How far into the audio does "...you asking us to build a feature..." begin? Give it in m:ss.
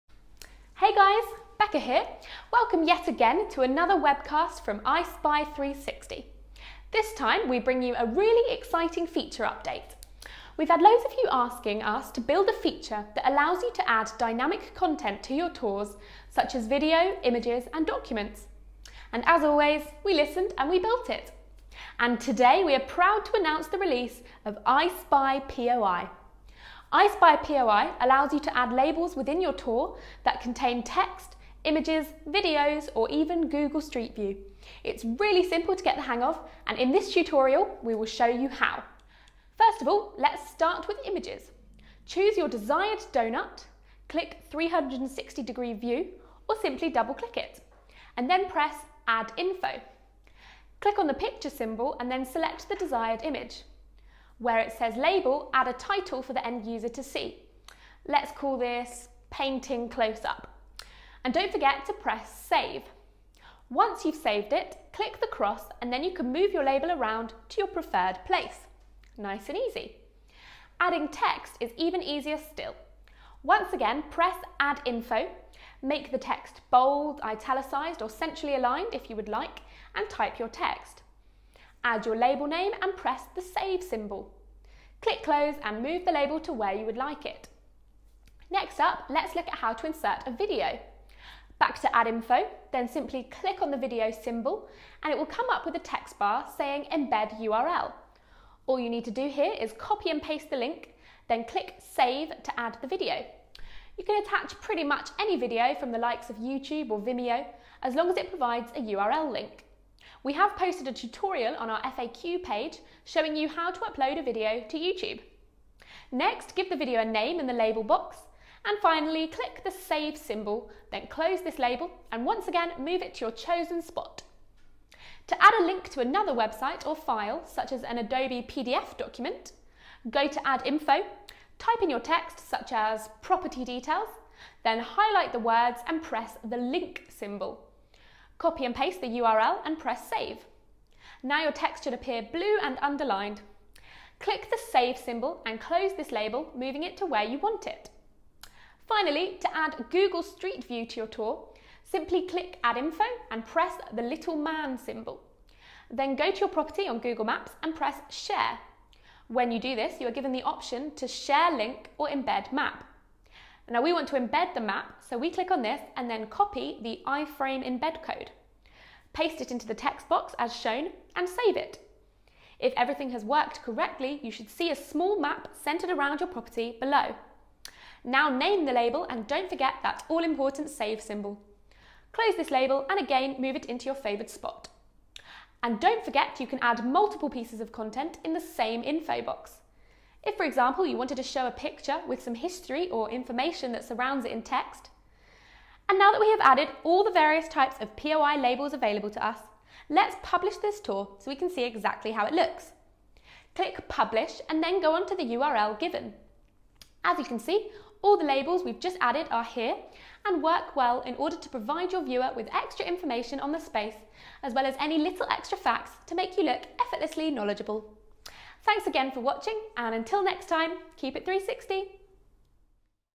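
0:11.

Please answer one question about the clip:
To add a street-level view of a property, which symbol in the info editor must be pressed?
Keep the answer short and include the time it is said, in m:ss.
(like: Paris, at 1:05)
little man symbol, at 2:34.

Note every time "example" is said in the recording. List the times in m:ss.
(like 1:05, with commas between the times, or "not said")
3:10.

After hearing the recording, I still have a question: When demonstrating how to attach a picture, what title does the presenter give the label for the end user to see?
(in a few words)
painting close up.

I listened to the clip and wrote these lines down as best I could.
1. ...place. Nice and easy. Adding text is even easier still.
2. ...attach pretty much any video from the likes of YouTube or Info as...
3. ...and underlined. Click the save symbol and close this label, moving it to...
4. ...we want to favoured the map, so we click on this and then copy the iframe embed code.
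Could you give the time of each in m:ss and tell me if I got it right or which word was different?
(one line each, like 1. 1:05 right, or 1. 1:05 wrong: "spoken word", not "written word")
1. 1:08 right
2. 1:44 wrong: "Vimeo", not "Info"
3. 2:22 right
4. 2:43 wrong: "embed", not "favoured".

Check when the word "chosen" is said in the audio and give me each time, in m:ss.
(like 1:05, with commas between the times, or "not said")
2:03.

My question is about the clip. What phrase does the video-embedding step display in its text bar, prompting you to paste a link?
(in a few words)
embed URL.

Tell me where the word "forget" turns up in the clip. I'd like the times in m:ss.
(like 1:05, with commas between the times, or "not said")
1:01, 2:59, 3:06.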